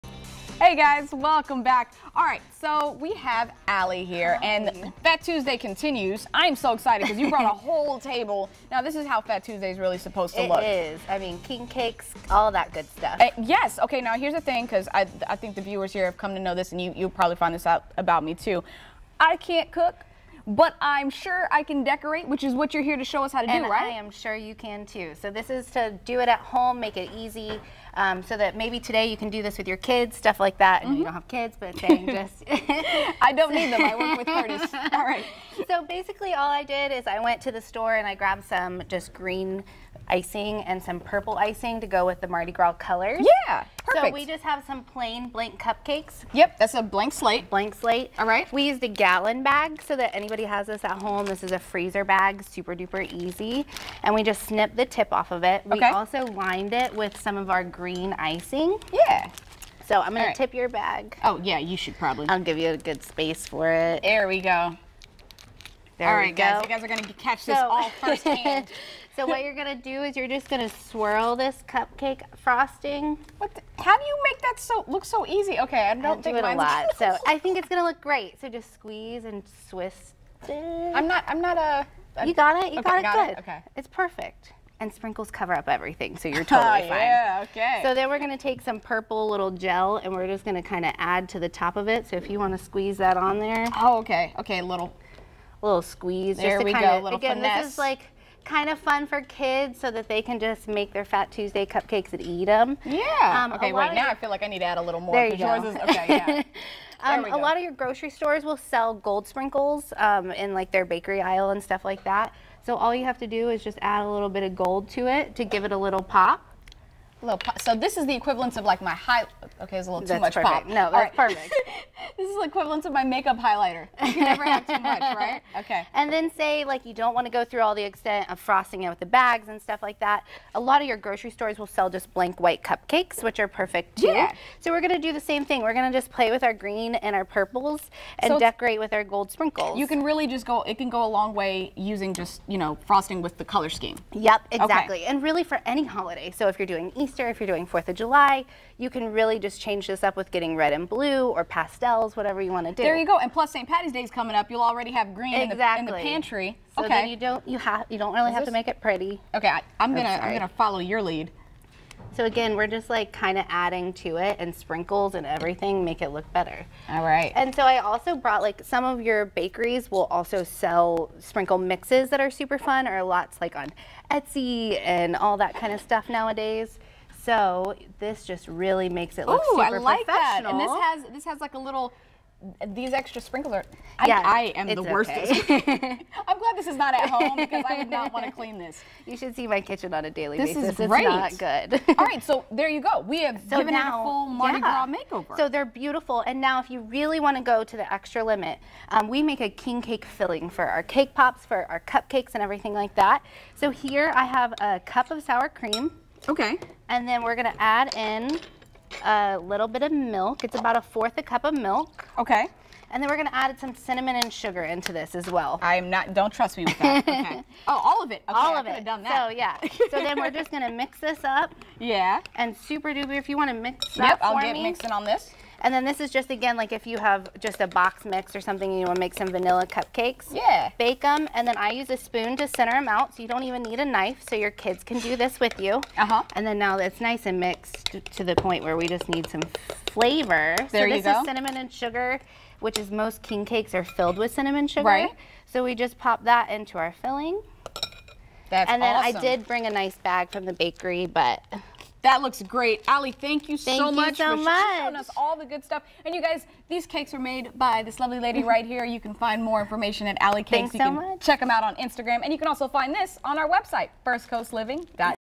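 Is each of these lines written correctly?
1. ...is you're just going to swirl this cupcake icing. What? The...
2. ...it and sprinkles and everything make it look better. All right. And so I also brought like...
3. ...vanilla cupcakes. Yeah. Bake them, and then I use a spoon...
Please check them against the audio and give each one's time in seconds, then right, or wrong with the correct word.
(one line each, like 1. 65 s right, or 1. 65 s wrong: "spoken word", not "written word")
1. 70 s wrong: "frosting", not "icing"
2. 164 s right
3. 229 s right.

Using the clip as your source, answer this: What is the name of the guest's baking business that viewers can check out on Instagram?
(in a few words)
Alley Cakes.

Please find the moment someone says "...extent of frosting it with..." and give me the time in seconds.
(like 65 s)
127 s.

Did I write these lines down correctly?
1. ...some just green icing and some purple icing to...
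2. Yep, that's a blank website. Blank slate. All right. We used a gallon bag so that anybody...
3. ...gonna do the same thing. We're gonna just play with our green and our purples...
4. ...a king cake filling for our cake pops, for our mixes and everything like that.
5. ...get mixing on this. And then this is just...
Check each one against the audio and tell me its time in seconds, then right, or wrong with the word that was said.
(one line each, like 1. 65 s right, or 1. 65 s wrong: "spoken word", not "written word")
1. 38 s right
2. 46 s wrong: "slate", not "website"
3. 134 s right
4. 199 s wrong: "cupcakes", not "mixes"
5. 224 s right.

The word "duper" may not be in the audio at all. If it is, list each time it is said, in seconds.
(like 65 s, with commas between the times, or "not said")
52 s, 222 s.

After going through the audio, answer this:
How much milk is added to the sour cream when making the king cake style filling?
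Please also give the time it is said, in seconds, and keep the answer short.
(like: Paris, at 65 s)
A fourth a cup, at 210 s.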